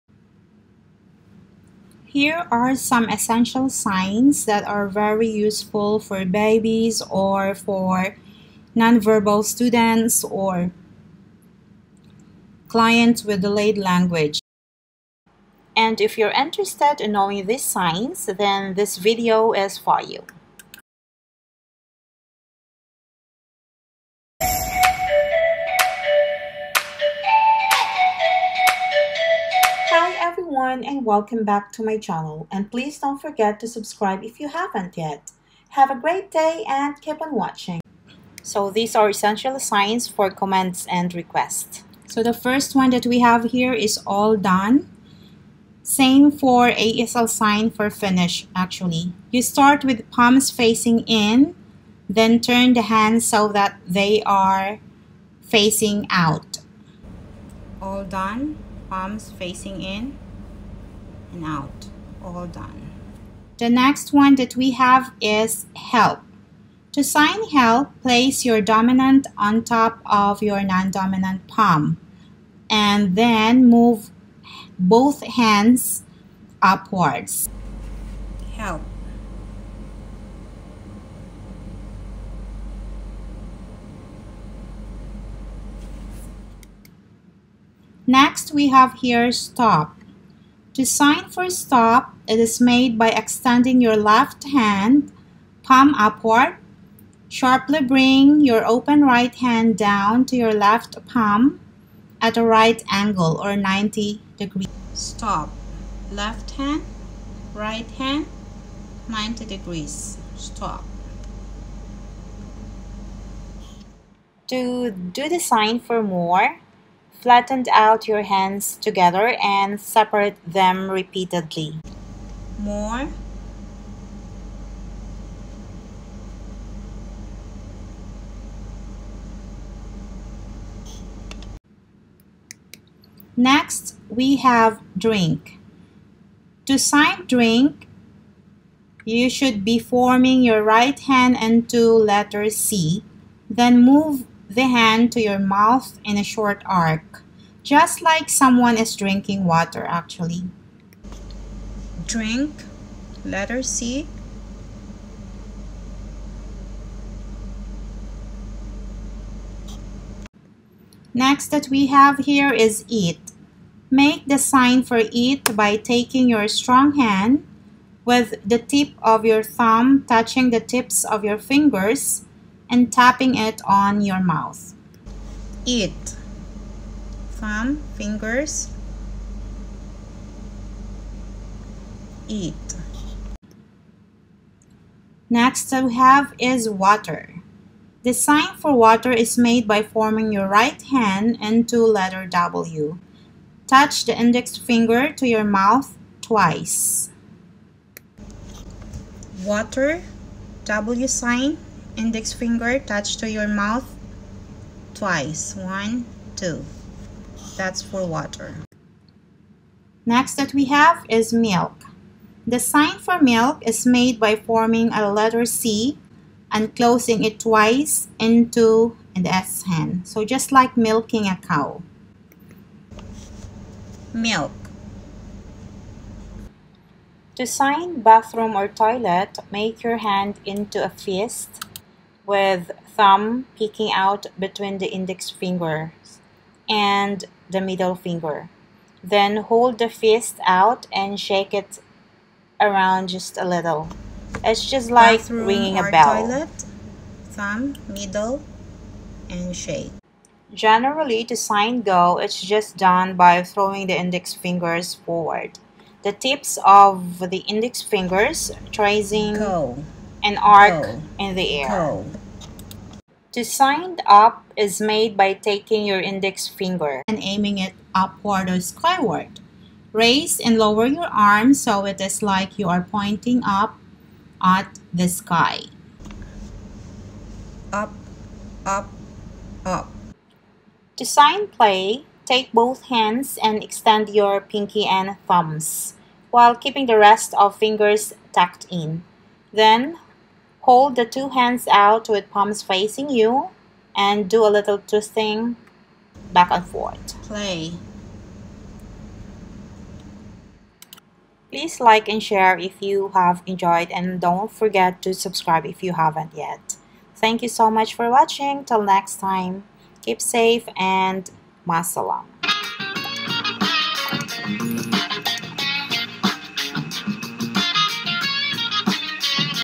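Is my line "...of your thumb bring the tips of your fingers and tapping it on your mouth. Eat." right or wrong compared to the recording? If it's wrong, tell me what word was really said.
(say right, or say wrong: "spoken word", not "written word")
wrong: "touching", not "bring".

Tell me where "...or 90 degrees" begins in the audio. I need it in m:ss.
1:43.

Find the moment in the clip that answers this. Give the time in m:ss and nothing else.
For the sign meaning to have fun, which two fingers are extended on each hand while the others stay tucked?
4:44.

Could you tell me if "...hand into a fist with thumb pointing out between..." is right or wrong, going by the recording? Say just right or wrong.
wrong.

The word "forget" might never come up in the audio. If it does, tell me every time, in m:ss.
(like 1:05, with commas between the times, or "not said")
0:33, 5:04.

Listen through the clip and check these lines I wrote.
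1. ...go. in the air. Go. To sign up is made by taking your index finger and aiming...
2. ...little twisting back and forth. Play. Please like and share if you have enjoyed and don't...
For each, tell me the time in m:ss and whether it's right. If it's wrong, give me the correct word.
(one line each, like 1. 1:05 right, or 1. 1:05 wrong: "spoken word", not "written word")
1. 4:20 right
2. 4:54 right.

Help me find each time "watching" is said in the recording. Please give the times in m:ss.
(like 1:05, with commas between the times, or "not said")
0:37, 5:08.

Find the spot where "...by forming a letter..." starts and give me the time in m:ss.
3:34.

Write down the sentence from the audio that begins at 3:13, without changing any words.
Touch the index finger to your mouth twice.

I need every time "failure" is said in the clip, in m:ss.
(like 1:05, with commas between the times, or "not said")
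not said.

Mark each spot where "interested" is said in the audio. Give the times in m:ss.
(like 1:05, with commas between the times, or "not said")
0:16.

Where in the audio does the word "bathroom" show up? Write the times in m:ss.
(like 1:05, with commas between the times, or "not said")
3:48, 4:05.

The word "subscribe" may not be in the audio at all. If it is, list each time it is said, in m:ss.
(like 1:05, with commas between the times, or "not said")
0:33, 5:05.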